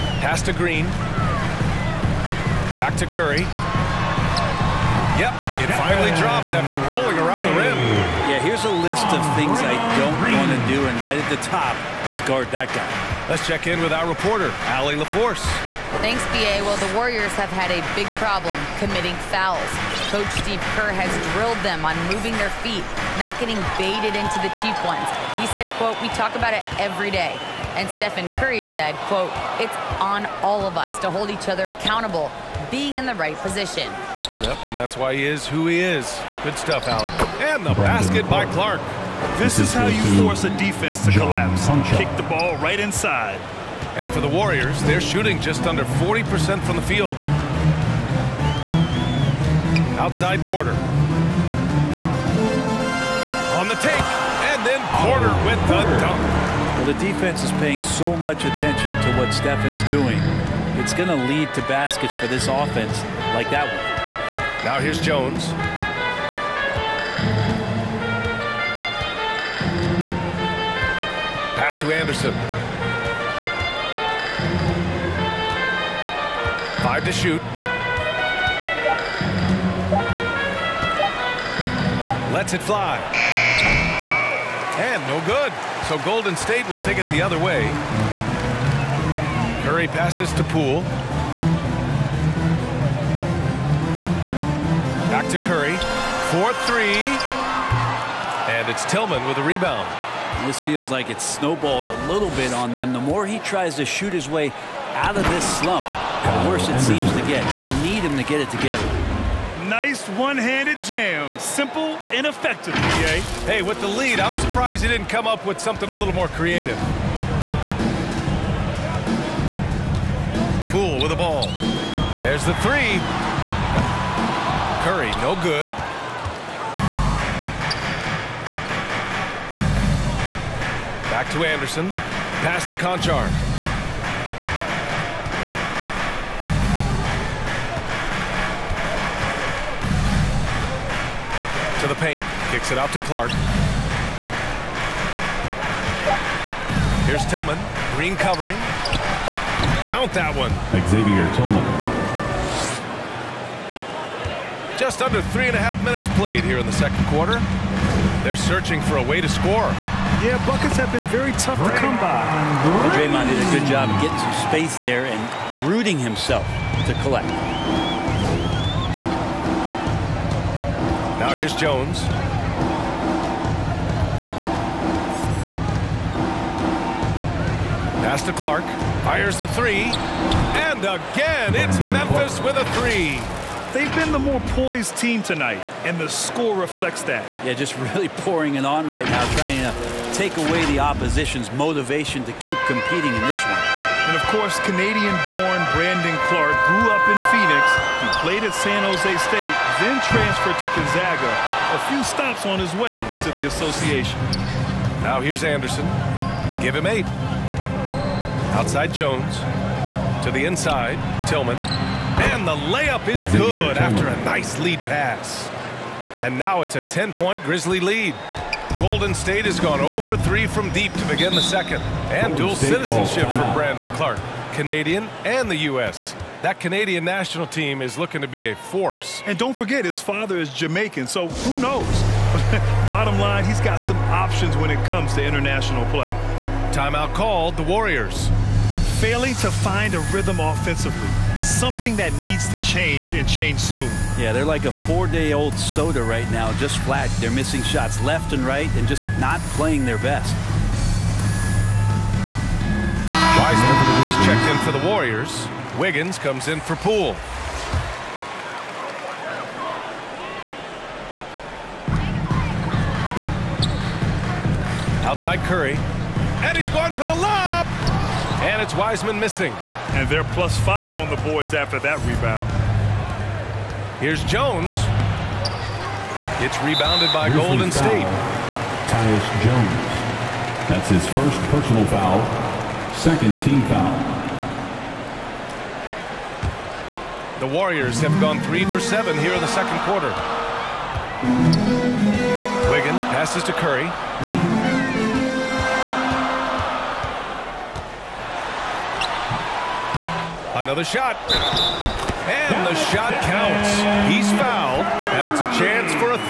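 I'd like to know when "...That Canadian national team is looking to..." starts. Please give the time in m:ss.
3:46.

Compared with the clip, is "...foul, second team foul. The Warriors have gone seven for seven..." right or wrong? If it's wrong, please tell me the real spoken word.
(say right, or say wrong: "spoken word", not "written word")
wrong: "three", not "seven".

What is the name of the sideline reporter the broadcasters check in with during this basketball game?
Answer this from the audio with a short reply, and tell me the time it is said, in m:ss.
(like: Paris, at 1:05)
Allie LaForce, at 0:14.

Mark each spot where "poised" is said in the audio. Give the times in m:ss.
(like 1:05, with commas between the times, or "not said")
3:04.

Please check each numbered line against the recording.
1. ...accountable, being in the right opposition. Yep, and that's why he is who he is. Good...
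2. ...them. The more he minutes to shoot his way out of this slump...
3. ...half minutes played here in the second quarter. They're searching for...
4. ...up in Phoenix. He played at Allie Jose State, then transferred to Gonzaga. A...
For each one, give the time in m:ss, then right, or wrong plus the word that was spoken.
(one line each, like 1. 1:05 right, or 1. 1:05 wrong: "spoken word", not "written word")
1. 0:31 wrong: "position", not "opposition"
2. 1:42 wrong: "tries", not "minutes"
3. 2:35 right
4. 3:16 wrong: "San", not "Allie".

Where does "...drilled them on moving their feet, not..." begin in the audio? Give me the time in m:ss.
0:21.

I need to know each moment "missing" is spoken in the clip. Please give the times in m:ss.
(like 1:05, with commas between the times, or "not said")
4:07, 4:29.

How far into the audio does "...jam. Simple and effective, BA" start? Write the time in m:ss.
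1:50.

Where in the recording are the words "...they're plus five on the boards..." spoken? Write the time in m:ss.
4:30.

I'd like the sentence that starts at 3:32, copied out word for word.
And the layup is good after a nice lead pass.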